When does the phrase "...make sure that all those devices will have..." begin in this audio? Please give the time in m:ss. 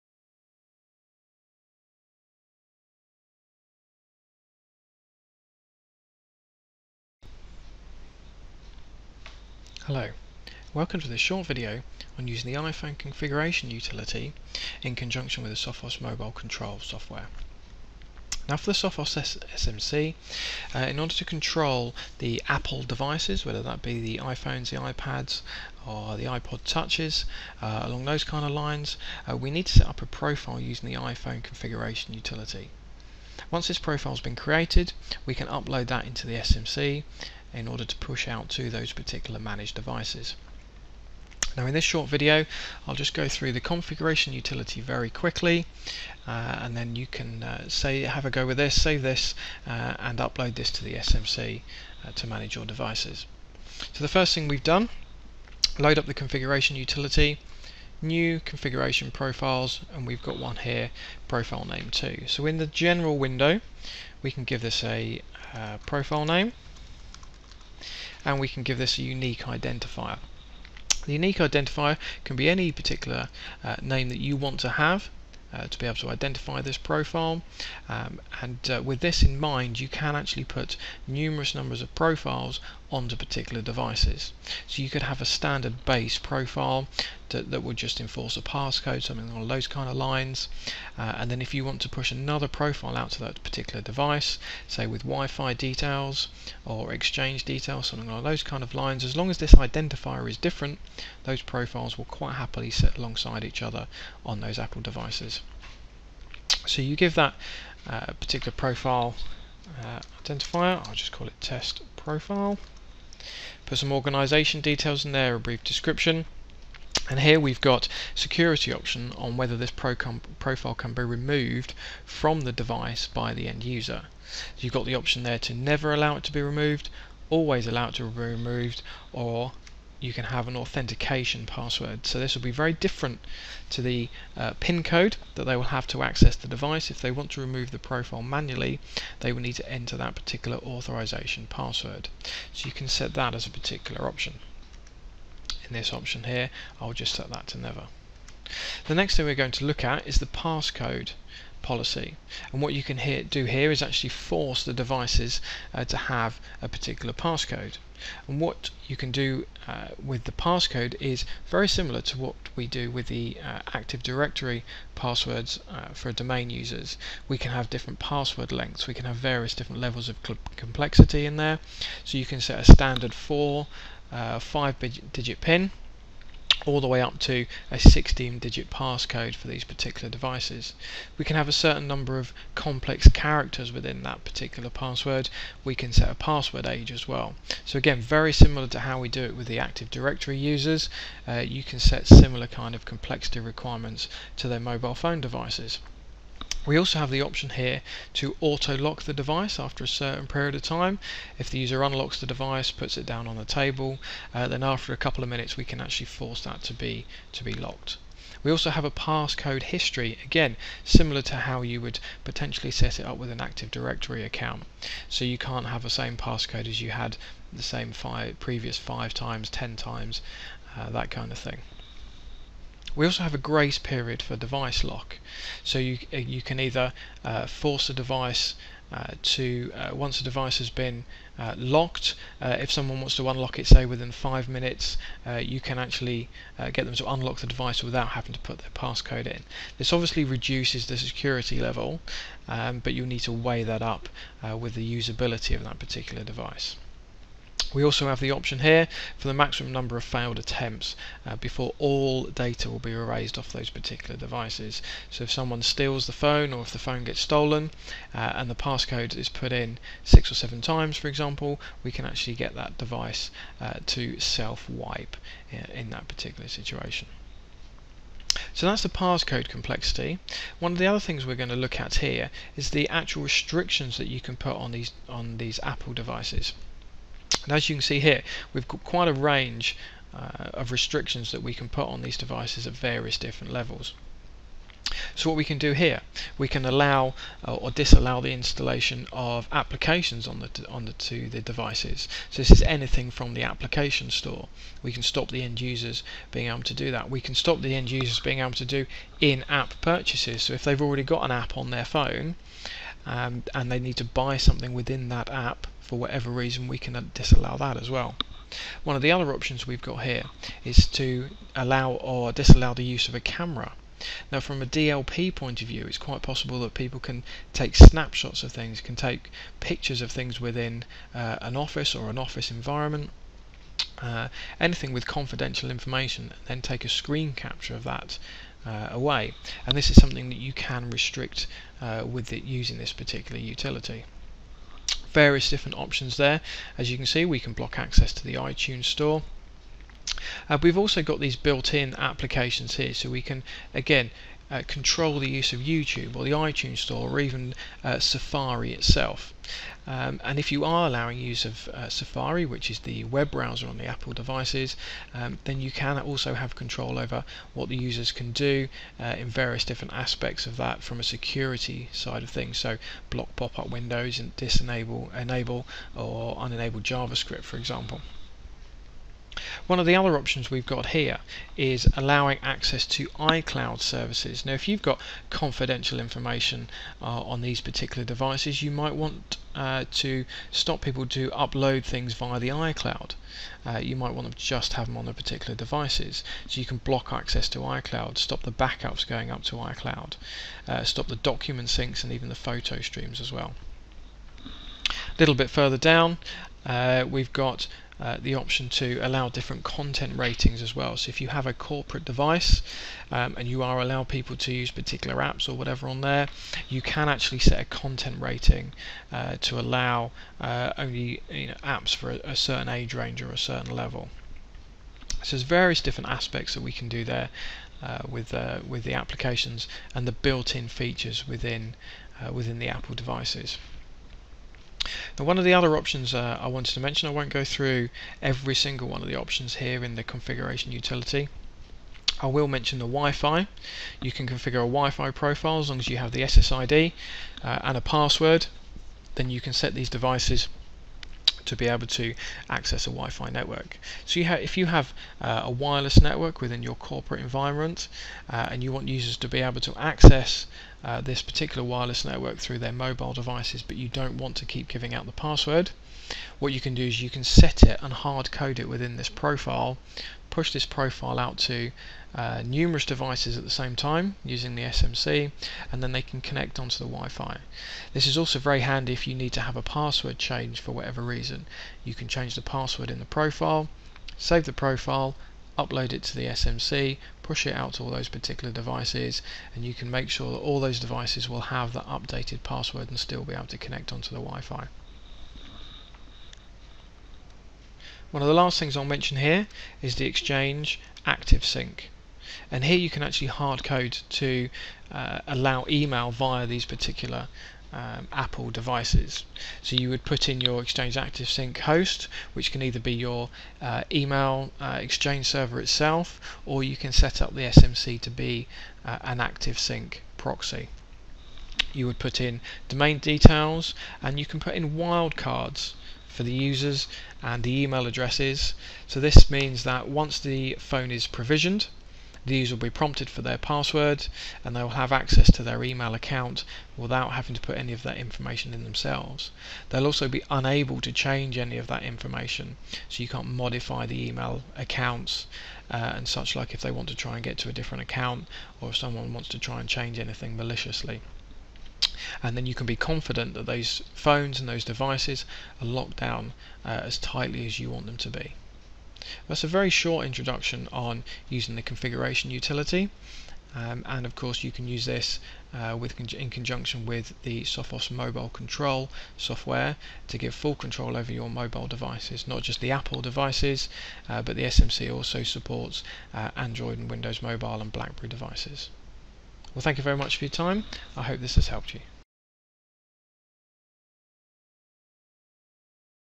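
7:59.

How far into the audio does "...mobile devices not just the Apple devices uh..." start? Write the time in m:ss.
9:21.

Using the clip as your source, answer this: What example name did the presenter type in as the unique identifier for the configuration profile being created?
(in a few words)
test profile.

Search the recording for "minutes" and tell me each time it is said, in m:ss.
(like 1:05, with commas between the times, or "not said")
3:25, 3:54.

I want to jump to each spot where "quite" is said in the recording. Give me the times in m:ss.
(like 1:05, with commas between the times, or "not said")
1:42, 4:38, 5:15.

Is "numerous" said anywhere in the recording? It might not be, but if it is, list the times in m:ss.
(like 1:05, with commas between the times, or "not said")
1:21, 7:42.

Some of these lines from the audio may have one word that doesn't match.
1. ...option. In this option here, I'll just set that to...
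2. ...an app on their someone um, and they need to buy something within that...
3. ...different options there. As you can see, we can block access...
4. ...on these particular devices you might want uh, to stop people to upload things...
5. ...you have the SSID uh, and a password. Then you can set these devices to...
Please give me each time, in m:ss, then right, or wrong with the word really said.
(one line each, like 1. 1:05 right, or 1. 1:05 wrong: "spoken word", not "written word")
1. 2:24 right
2. 5:01 wrong: "phone", not "someone"
3. 5:35 right
4. 6:17 right
5. 7:15 right.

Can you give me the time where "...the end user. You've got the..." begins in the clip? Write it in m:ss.
2:03.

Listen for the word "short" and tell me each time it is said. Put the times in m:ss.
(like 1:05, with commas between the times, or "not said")
0:11, 0:41, 9:09.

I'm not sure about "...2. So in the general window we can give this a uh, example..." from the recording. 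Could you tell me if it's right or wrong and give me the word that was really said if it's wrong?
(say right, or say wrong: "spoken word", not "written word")
wrong: "profile", not "example".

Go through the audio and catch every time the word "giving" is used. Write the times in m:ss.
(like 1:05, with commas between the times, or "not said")
7:34.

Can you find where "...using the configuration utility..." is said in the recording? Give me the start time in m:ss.
9:11.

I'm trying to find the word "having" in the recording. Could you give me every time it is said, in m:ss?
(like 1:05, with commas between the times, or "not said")
3:58, 8:47.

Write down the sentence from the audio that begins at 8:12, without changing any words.
And here you can actually hard code to uh, allow email via these particular um, Apple devices.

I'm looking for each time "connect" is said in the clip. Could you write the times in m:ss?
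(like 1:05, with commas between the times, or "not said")
7:46, 8:03.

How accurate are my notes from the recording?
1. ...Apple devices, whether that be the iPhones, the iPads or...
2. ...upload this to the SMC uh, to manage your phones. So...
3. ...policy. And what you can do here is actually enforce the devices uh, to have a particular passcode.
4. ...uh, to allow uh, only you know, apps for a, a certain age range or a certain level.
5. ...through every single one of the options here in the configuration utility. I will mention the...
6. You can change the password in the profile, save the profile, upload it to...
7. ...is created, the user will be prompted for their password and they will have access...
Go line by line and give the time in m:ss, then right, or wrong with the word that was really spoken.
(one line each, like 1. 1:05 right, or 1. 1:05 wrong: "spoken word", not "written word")
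1. 0:22 right
2. 0:50 wrong: "devices", not "phones"
3. 2:31 wrong: "force", not "enforce"
4. 6:49 right
5. 7:07 right
6. 7:51 right
7. 8:40 wrong: "provisioned", not "created".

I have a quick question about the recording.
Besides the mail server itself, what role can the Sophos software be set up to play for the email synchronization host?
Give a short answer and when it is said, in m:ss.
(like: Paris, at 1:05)
Active Sync proxy, at 8:29.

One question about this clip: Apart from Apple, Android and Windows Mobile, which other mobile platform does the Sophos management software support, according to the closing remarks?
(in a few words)
Blackberry.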